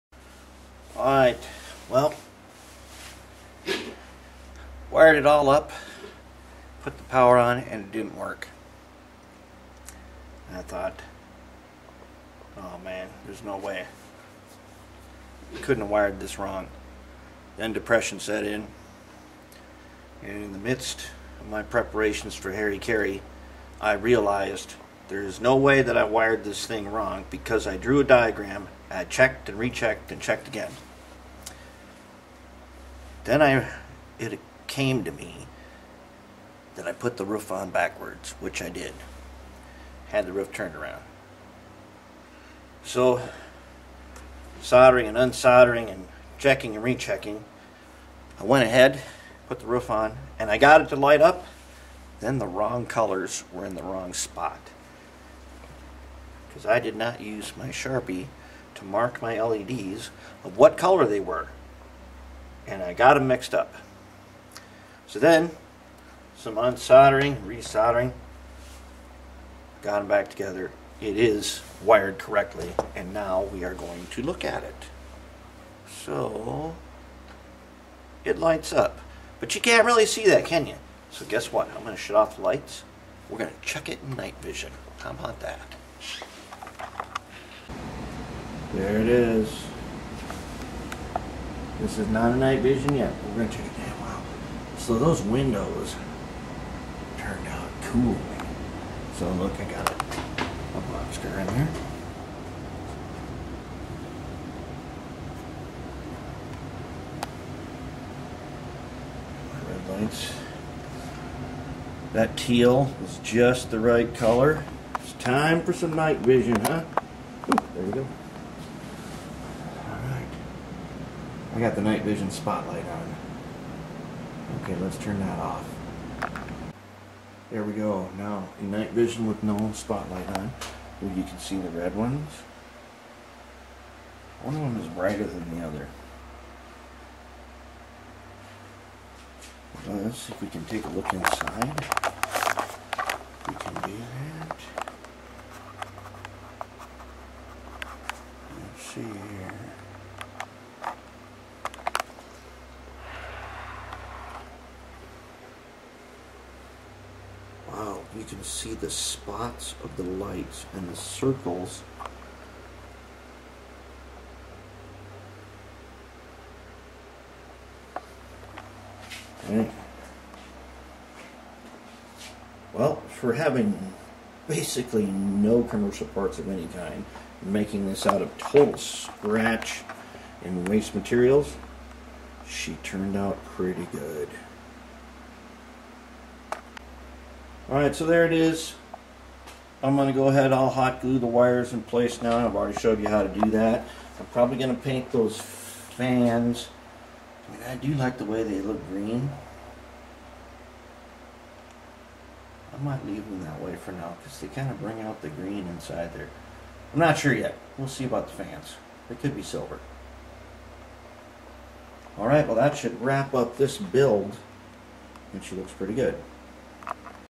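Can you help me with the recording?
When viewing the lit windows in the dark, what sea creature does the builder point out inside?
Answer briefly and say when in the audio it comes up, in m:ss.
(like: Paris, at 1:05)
A lobster, at 1:40.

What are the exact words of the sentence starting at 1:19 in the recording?
But you can't really see that, can you?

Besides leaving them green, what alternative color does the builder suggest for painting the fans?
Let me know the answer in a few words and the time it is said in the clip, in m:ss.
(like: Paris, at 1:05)
Silver, at 3:29.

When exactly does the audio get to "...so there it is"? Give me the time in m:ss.
3:07.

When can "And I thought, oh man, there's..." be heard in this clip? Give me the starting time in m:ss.
0:10.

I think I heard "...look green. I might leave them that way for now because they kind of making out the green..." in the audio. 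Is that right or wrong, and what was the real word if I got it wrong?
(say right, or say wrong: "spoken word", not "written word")
wrong: "bring", not "making".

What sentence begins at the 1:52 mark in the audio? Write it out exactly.
That teal is just the right color.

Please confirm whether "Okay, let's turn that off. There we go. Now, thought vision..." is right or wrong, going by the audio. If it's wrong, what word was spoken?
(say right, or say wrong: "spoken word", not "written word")
wrong: "night", not "thought".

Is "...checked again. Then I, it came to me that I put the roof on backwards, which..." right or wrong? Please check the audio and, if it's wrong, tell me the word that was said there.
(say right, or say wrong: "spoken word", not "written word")
right.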